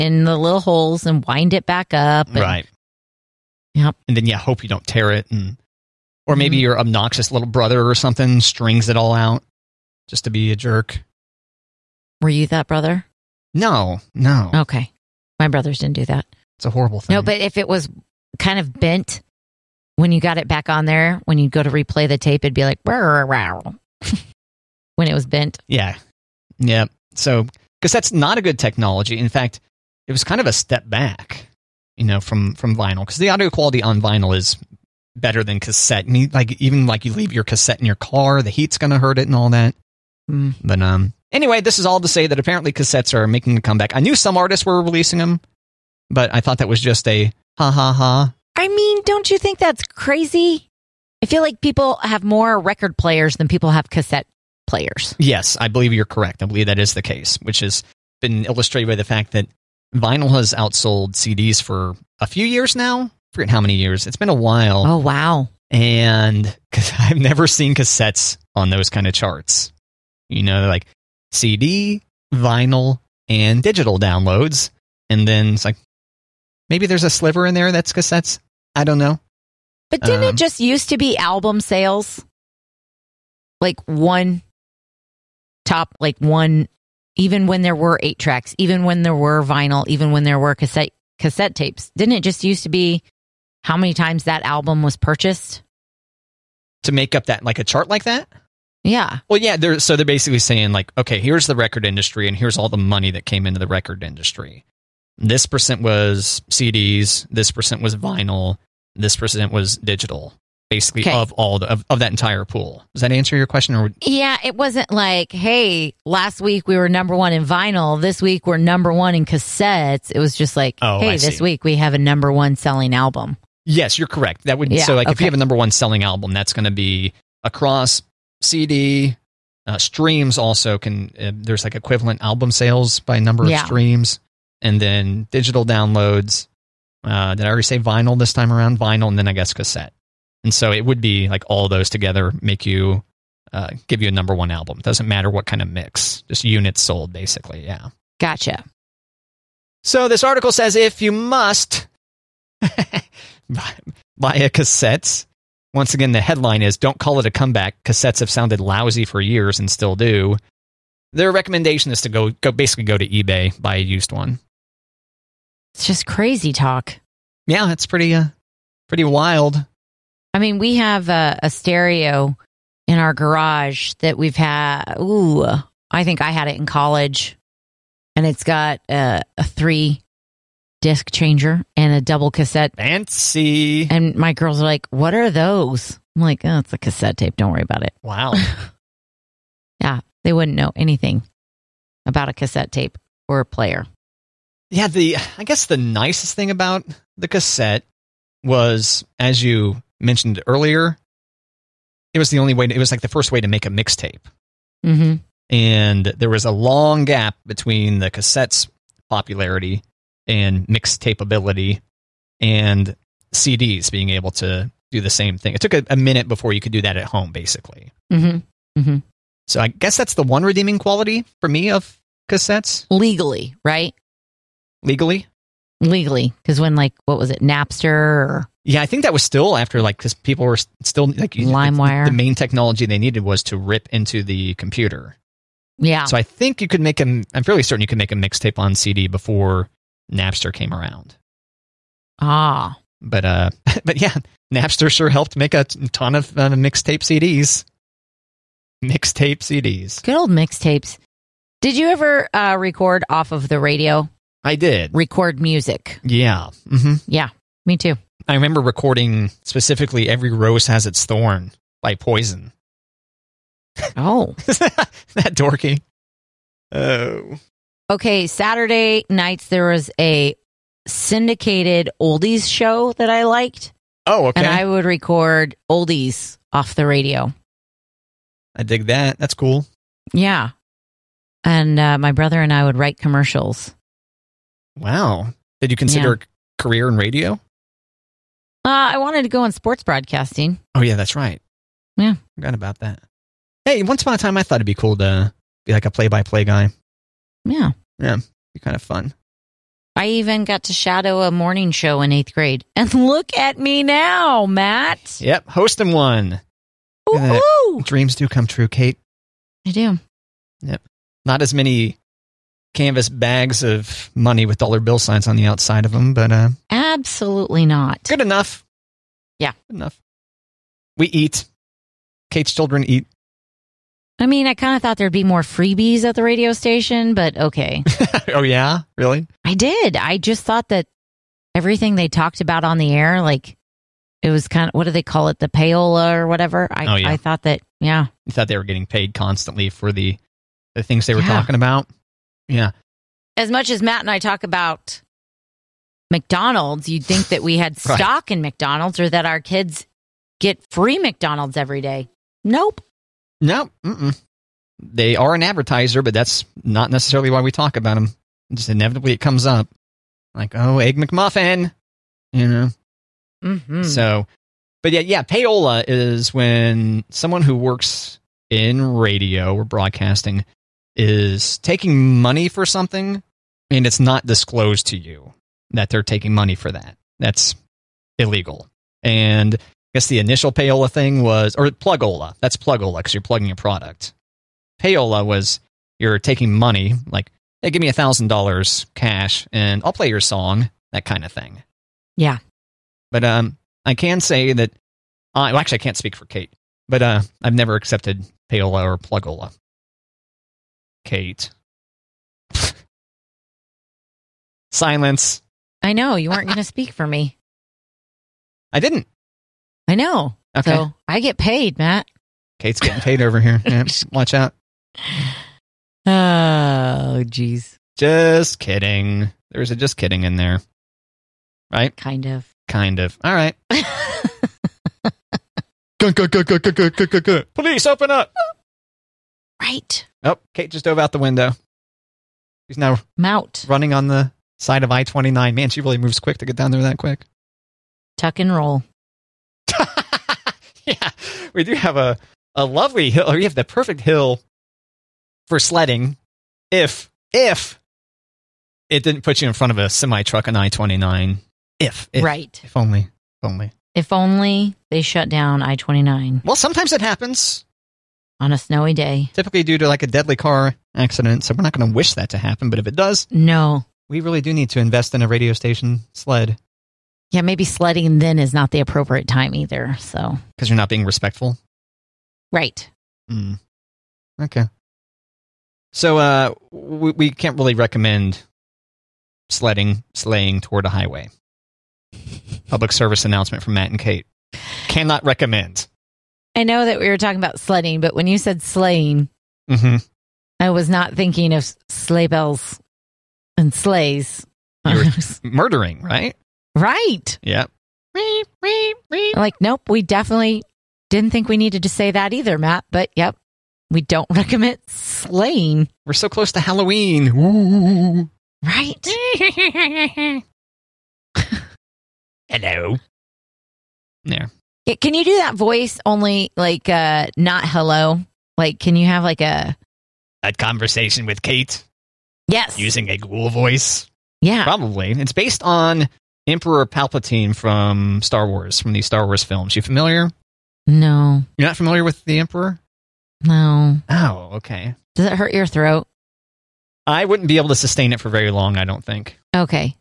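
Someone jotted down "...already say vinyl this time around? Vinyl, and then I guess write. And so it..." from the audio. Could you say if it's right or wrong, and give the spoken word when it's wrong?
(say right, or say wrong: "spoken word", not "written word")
wrong: "cassette", not "write".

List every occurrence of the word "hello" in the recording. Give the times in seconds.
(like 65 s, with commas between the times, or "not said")
512 s, 517 s.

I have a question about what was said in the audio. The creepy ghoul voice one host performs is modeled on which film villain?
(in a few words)
Emperor Palpatine.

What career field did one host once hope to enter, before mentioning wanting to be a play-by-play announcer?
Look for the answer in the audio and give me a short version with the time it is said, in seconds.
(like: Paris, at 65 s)
sports broadcasting, at 289 s.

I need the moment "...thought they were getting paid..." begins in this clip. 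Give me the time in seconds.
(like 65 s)
338 s.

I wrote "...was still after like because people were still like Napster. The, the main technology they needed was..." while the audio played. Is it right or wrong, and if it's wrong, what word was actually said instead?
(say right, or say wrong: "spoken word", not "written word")
wrong: "LimeWire", not "Napster".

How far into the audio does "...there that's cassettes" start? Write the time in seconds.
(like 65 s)
77 s.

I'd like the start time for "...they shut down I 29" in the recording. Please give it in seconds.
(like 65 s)
454 s.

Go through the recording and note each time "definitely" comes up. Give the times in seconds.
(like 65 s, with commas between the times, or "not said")
500 s.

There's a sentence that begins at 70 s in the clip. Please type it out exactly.
You know, like CD, vinyl, and digital downloads.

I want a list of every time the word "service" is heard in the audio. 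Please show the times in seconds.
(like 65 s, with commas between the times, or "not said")
482 s.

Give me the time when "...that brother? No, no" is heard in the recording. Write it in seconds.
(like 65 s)
12 s.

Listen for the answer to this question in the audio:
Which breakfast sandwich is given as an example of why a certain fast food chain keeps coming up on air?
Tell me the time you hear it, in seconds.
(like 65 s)
360 s.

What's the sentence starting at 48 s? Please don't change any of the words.
I mean, don't you think that's crazy?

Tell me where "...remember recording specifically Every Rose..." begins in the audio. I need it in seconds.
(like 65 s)
258 s.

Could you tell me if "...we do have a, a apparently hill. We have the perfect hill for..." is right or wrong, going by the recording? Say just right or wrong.
wrong.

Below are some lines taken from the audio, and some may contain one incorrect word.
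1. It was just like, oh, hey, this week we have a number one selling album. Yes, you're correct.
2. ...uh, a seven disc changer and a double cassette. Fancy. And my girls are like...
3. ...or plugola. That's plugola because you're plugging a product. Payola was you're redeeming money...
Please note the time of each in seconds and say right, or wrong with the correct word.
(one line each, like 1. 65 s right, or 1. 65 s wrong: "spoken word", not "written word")
1. 120 s right
2. 178 s wrong: "three", not "seven"
3. 381 s wrong: "taking", not "redeeming".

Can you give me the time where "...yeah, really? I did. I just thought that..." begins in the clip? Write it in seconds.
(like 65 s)
328 s.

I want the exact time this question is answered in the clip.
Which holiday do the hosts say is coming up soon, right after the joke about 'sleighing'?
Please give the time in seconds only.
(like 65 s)
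506 s.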